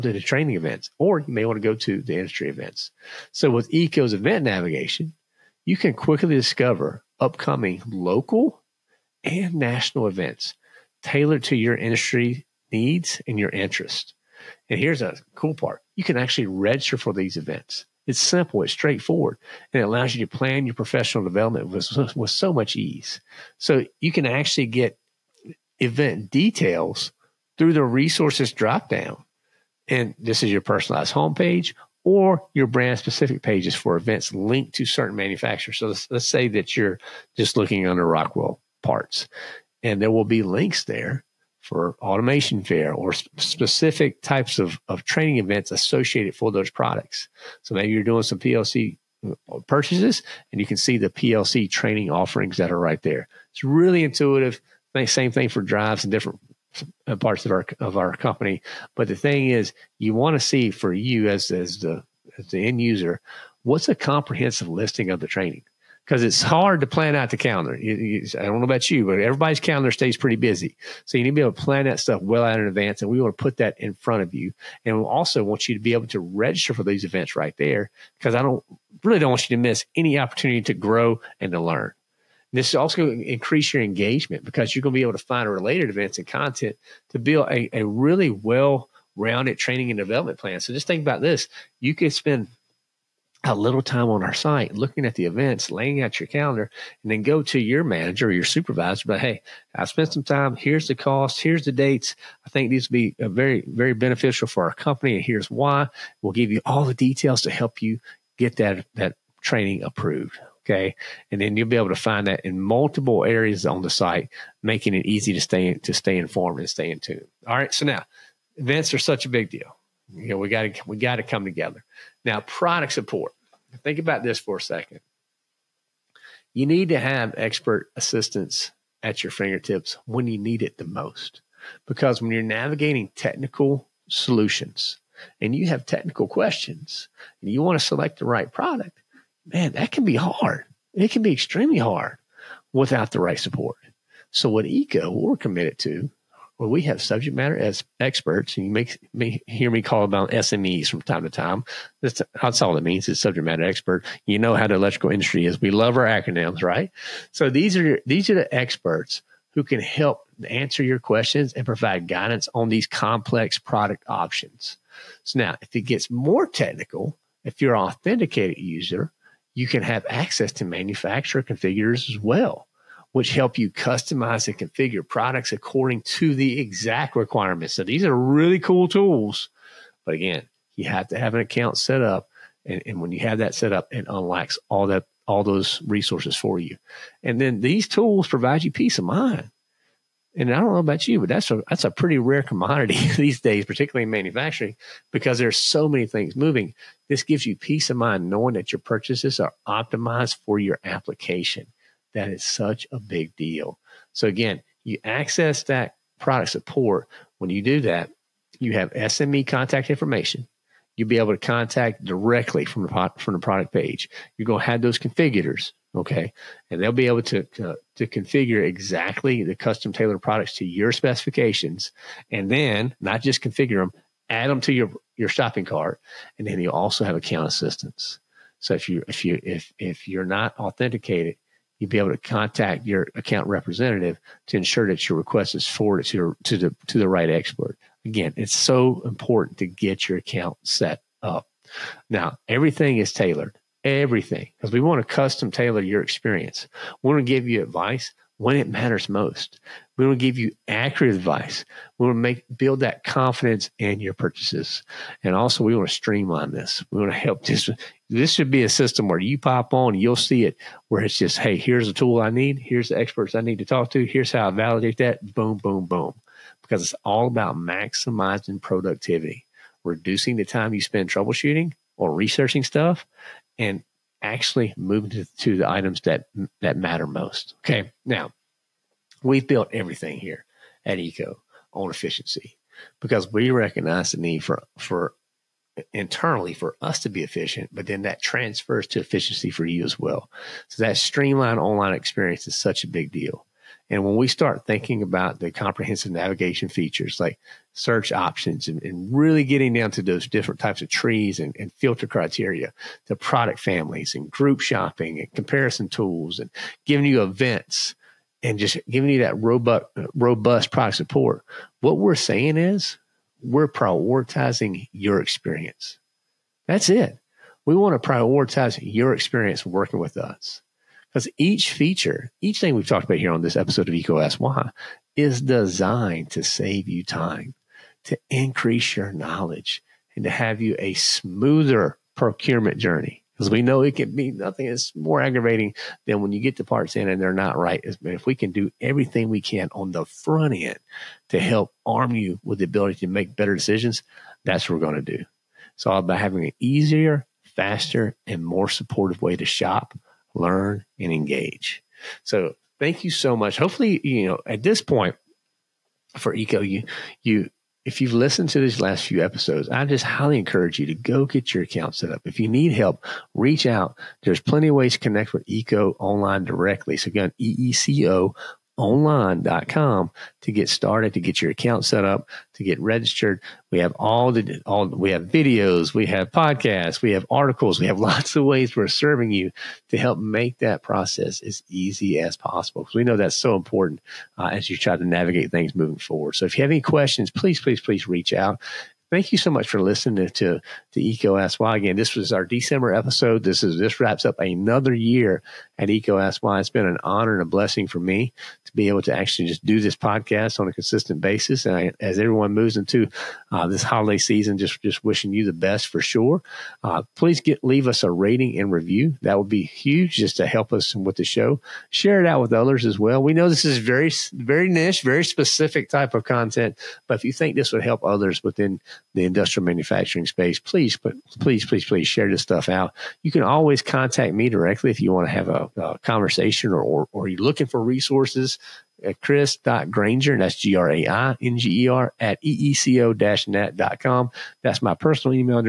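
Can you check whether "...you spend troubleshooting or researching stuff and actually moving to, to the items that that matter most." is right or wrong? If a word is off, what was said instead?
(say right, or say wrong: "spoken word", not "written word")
right.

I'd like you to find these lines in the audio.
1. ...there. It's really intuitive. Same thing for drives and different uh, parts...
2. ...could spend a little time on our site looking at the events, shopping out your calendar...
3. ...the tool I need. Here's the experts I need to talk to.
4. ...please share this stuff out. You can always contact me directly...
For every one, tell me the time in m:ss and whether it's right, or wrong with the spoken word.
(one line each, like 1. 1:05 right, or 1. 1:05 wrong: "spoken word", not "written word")
1. 0:53 right
2. 1:31 wrong: "laying", not "shopping"
3. 4:21 right
4. 7:01 right.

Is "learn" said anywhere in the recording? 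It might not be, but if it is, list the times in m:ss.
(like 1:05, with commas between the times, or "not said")
1:21, 5:50.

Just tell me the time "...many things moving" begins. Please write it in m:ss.
3:15.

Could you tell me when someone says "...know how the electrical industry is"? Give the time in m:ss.
2:34.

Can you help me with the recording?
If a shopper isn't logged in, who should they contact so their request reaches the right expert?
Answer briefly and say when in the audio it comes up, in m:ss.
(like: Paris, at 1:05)
account representative, at 3:53.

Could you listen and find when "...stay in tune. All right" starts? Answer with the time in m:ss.
1:56.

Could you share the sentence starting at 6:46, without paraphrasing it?
Uh, please get leave us a rating and review.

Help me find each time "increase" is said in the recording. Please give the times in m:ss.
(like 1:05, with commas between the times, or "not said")
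1:23, 5:28.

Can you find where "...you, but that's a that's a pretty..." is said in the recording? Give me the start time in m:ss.
3:11.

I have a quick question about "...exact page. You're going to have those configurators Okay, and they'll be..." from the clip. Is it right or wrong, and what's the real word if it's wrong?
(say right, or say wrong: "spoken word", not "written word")
wrong: "product", not "exact".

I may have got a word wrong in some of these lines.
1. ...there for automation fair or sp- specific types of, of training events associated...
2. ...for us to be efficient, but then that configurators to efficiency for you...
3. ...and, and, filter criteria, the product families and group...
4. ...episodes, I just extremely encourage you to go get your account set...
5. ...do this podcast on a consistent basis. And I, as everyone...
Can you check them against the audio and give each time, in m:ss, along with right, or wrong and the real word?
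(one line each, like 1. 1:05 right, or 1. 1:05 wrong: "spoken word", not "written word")
1. 0:40 right
2. 4:46 wrong: "transfers", not "configurators"
3. 5:01 right
4. 5:59 wrong: "highly", not "extremely"
5. 6:39 right.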